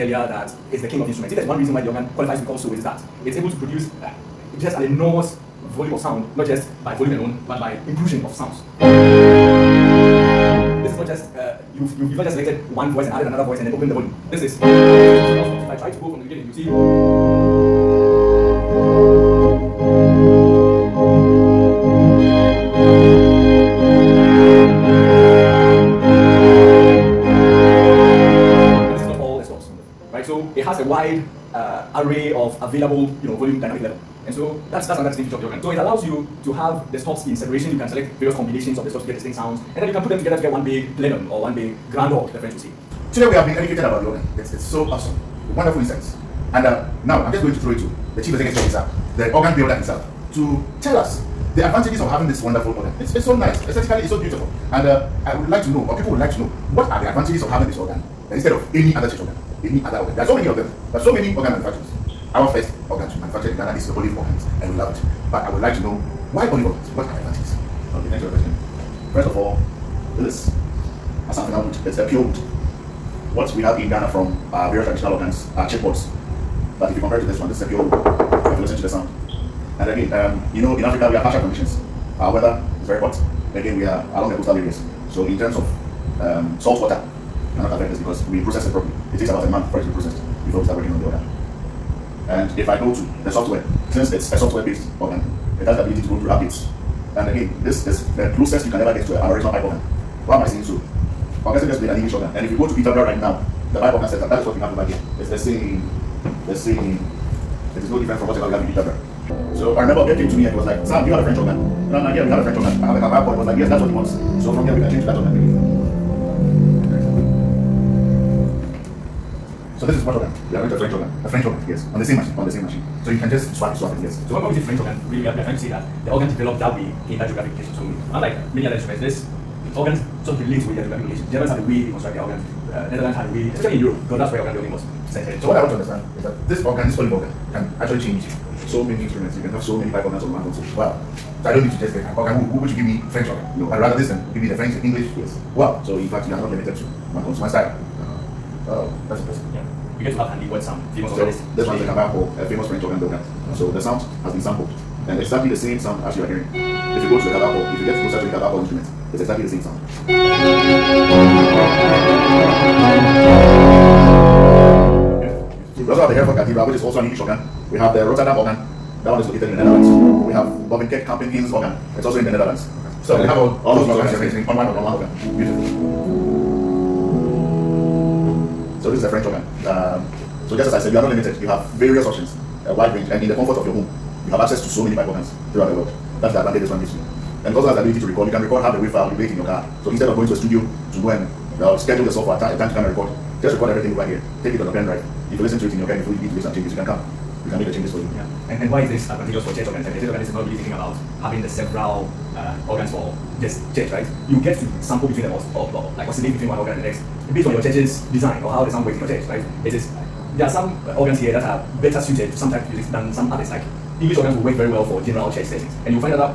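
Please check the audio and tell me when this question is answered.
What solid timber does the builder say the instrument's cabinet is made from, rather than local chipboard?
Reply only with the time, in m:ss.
1:11.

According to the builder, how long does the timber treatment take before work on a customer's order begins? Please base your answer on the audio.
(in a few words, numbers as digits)
About a month.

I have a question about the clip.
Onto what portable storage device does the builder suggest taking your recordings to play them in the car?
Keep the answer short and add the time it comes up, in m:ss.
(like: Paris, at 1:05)
Pen drive, at 3:14.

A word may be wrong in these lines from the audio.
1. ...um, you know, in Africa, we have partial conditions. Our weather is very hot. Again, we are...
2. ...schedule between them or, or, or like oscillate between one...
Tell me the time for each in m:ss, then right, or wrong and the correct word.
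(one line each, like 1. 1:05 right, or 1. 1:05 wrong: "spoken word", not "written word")
1. 1:20 right
2. 3:24 wrong: "sample", not "schedule".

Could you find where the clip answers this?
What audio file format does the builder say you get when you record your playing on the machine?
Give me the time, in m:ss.
3:08.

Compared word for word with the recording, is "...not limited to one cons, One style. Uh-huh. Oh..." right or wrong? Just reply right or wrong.
right.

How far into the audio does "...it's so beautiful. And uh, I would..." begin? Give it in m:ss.
0:54.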